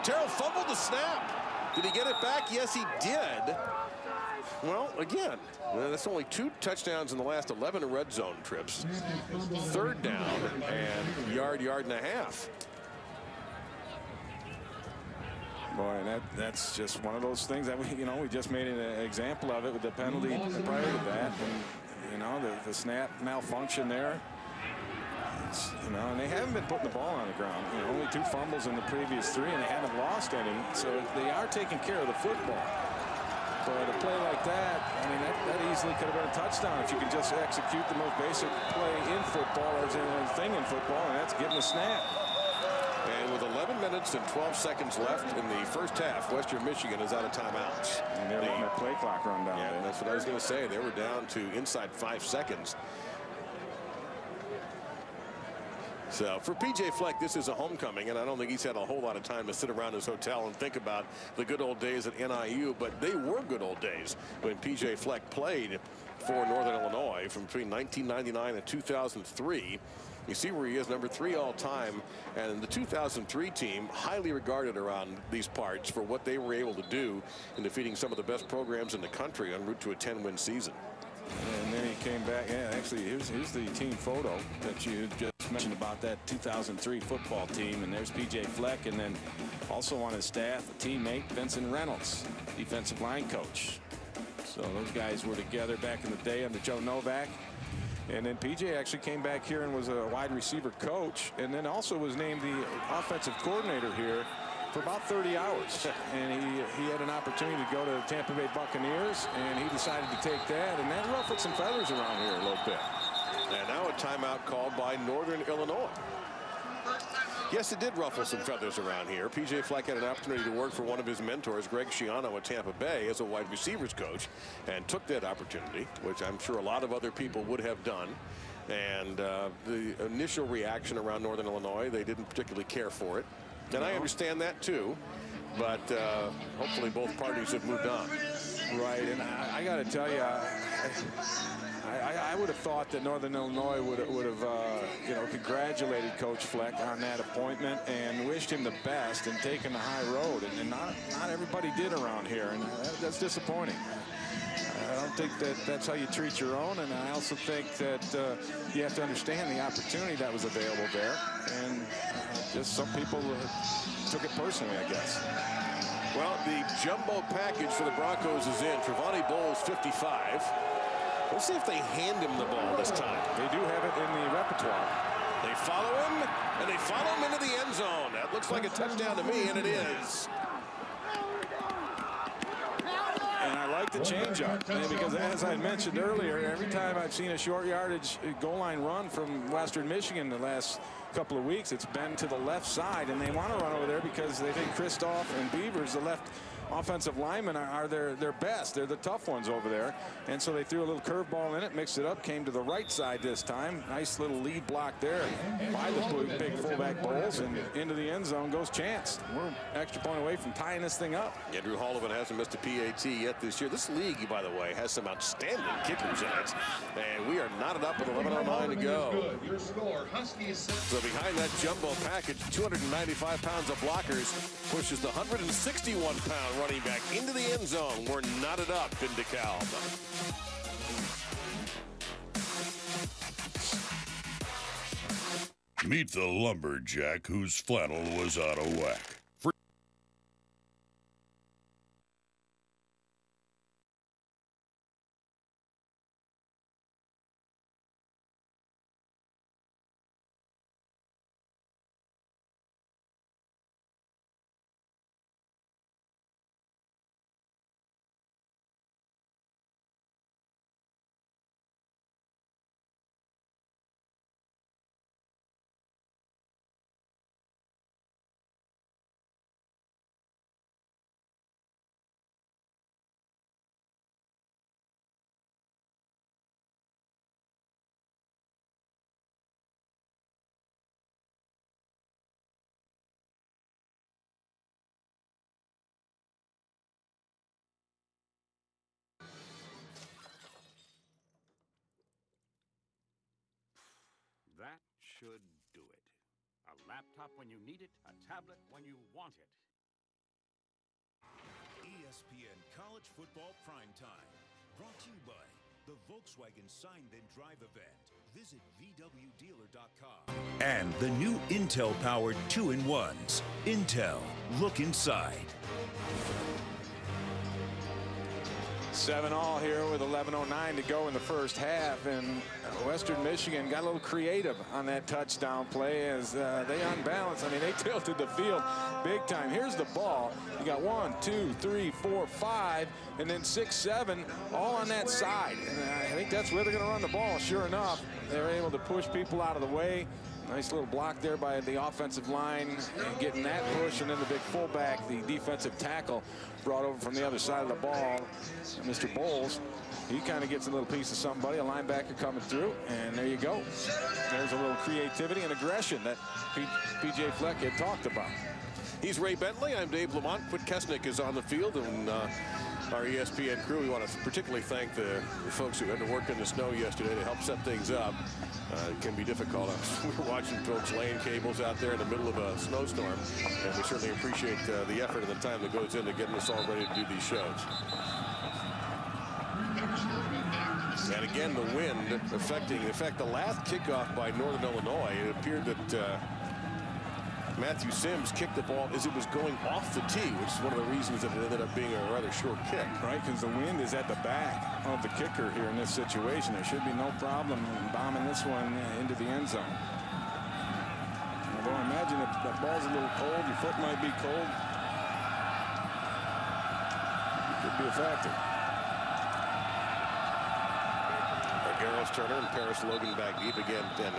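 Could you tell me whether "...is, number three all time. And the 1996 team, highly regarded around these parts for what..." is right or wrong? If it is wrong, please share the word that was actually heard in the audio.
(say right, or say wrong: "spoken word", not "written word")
wrong: "2003", not "1996".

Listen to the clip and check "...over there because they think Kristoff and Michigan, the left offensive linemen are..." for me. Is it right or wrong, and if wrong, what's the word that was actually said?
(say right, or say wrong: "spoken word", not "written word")
wrong: "Beavers", not "Michigan".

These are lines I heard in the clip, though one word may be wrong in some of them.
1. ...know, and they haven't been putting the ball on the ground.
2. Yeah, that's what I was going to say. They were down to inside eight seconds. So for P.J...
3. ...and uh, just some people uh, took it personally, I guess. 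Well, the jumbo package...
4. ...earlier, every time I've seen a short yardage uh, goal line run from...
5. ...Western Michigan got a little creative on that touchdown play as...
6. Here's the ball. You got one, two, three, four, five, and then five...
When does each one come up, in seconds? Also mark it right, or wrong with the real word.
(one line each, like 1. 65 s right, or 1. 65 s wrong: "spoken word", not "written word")
1. 25 s right
2. 49 s wrong: "five", not "eight"
3. 161 s right
4. 185 s right
5. 322 s right
6. 329 s wrong: "six", not "five".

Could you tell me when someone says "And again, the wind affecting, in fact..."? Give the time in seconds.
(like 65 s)
381 s.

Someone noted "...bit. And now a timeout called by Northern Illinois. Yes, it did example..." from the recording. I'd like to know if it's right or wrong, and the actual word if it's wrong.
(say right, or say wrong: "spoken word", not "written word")
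wrong: "ruffle", not "example".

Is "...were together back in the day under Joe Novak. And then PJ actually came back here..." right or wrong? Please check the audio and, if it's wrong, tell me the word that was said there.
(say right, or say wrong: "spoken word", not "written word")
right.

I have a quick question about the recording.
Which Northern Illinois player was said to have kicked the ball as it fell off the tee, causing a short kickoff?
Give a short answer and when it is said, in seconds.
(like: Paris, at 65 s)
Matthew Sims, at 387 s.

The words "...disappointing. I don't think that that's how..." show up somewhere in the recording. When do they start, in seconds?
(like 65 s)
153 s.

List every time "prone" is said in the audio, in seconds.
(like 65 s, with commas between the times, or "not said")
not said.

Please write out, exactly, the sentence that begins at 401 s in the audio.
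Although I imagine if the ball's a little cold, your foot might be cold.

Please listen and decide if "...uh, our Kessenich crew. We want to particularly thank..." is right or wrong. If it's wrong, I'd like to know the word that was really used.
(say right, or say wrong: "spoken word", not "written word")
wrong: "ESPN", not "Kessenich".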